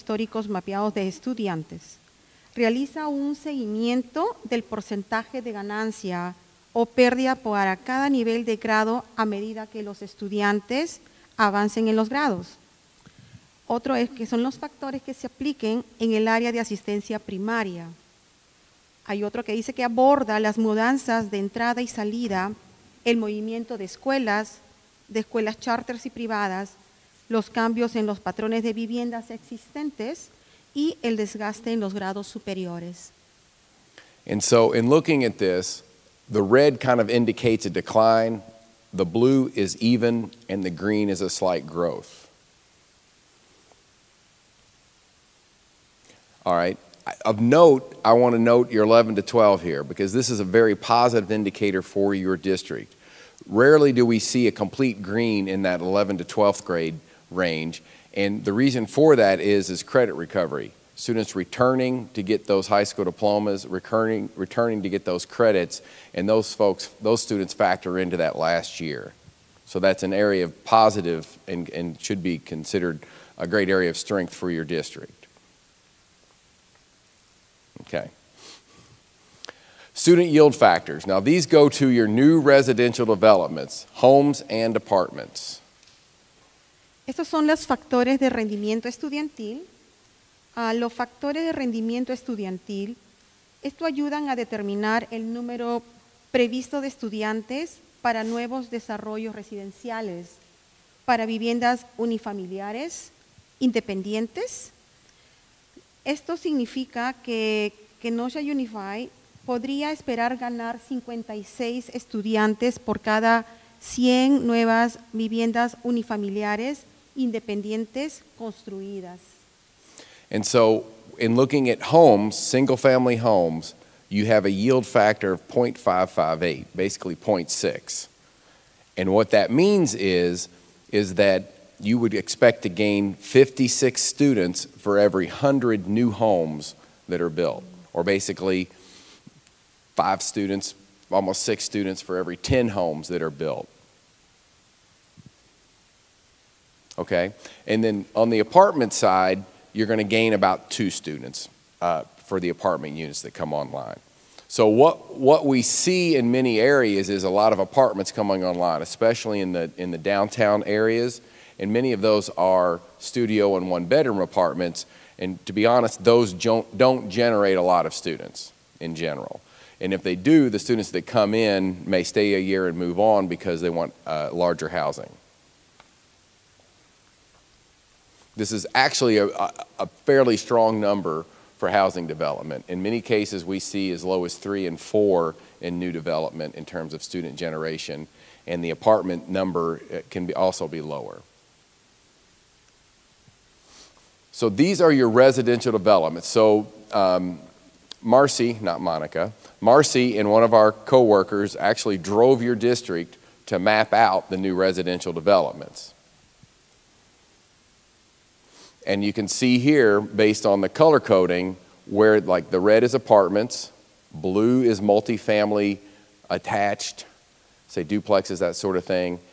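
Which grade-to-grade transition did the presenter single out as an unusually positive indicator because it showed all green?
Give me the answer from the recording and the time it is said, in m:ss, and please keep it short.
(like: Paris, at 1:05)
11 to 12, at 0:48.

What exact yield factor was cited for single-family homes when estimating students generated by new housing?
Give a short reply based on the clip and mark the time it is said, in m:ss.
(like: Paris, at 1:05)
0.558, at 2:05.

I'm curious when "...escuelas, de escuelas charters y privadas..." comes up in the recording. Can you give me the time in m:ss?
0:23.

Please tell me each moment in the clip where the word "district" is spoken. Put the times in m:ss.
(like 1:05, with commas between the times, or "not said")
0:52, 1:14, 3:22.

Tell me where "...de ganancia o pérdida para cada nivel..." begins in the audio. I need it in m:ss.
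0:05.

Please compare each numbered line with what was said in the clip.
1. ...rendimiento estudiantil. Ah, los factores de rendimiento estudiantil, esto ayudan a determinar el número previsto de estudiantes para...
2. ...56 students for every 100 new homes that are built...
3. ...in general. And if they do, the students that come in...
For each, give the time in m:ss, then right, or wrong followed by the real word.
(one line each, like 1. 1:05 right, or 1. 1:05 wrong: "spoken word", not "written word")
1. 1:28 right
2. 2:13 right
3. 2:48 right.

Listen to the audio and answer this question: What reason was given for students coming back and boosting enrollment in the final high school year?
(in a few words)
Credit recovery.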